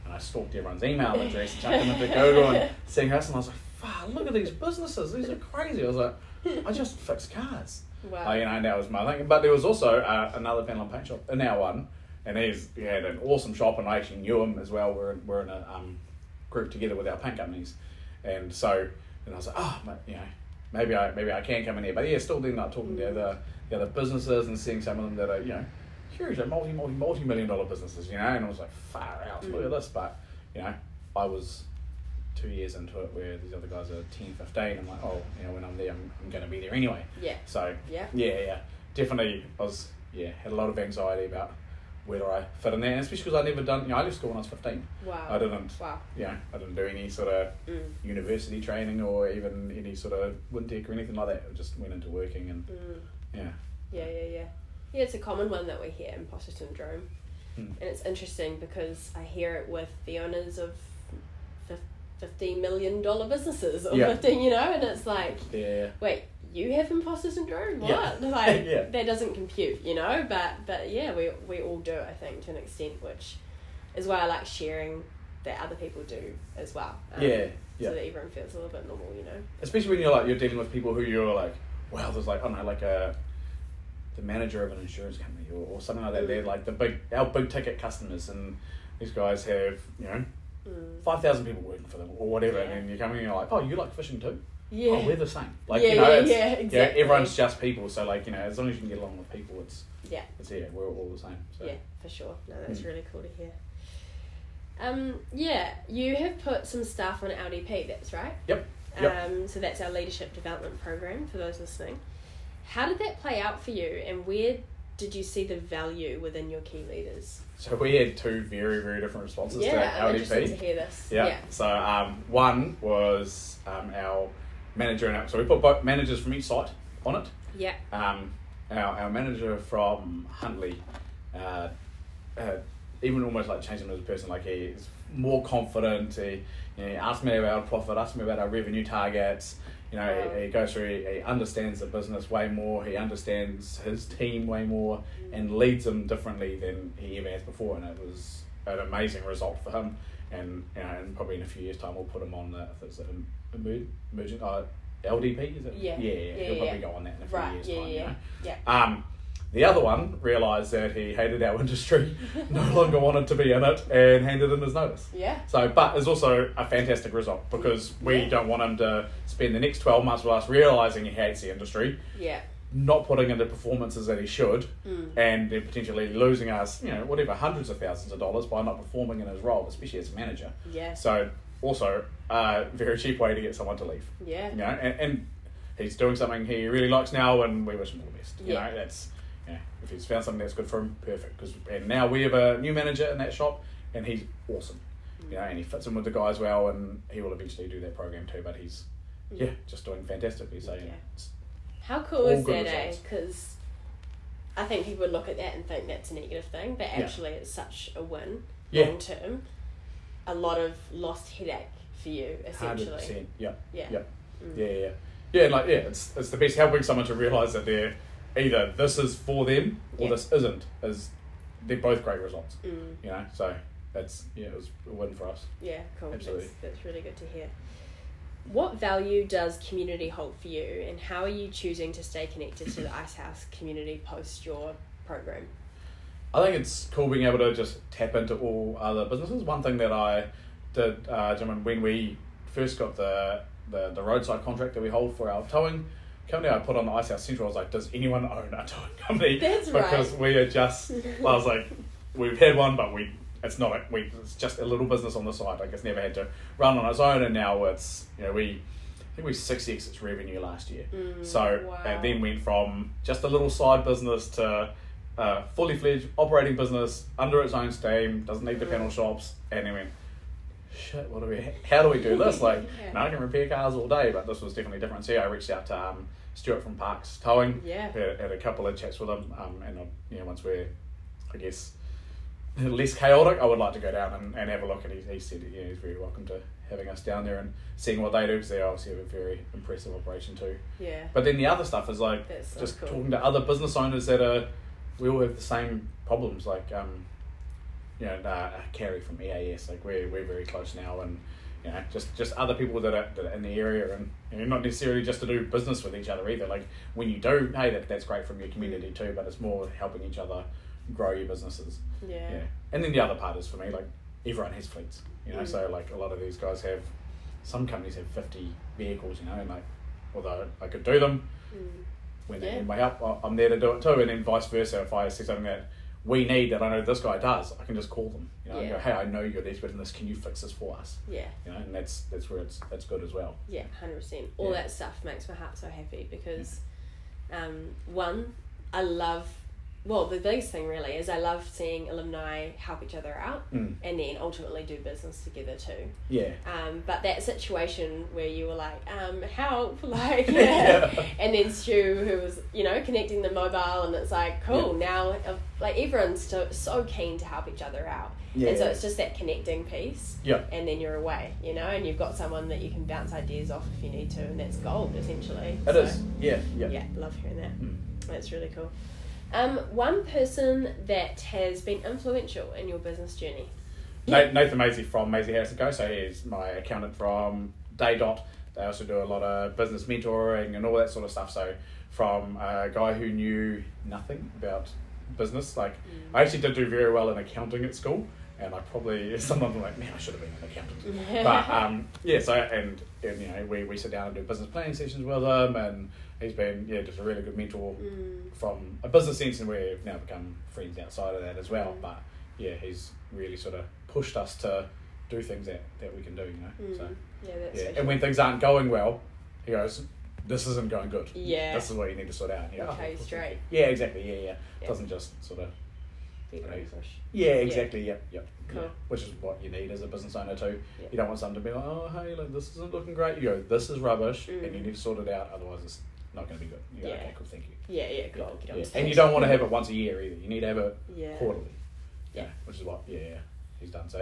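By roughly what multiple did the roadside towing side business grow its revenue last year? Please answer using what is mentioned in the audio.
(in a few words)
6x.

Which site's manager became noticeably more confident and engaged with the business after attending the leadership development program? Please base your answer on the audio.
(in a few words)
Huntly.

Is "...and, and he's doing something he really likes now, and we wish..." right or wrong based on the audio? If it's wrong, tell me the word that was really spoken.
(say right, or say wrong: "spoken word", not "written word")
right.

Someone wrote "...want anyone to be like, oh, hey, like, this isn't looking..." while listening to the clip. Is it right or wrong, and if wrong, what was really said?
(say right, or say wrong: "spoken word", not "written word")
wrong: "someone", not "anyone".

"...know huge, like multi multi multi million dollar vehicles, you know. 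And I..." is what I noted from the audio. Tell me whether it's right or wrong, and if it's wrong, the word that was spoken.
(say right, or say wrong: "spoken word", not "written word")
wrong: "businesses", not "vehicles".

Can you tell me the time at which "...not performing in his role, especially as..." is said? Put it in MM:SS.
02:58.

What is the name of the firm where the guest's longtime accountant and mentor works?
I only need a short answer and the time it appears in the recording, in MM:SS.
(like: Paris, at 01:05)
Maisie Harris and Co, at 06:15.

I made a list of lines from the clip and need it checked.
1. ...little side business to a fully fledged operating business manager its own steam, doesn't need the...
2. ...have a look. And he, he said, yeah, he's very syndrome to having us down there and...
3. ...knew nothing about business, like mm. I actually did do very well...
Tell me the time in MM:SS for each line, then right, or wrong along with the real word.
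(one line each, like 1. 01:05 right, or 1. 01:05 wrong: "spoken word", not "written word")
1. 04:23 wrong: "under", not "manager"
2. 04:44 wrong: "welcome", not "syndrome"
3. 06:23 right.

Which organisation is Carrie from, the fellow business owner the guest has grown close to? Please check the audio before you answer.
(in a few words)
EAS.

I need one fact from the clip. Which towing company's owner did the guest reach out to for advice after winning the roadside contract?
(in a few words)
Parks Towing.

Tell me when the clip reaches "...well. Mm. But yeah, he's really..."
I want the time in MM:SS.
06:41.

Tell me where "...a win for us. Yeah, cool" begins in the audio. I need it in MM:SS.
03:44.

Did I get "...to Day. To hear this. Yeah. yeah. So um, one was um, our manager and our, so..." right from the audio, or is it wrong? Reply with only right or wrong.
wrong.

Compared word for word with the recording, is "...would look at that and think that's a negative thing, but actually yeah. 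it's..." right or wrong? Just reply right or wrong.
right.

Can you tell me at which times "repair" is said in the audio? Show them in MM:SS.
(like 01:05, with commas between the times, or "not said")
04:33.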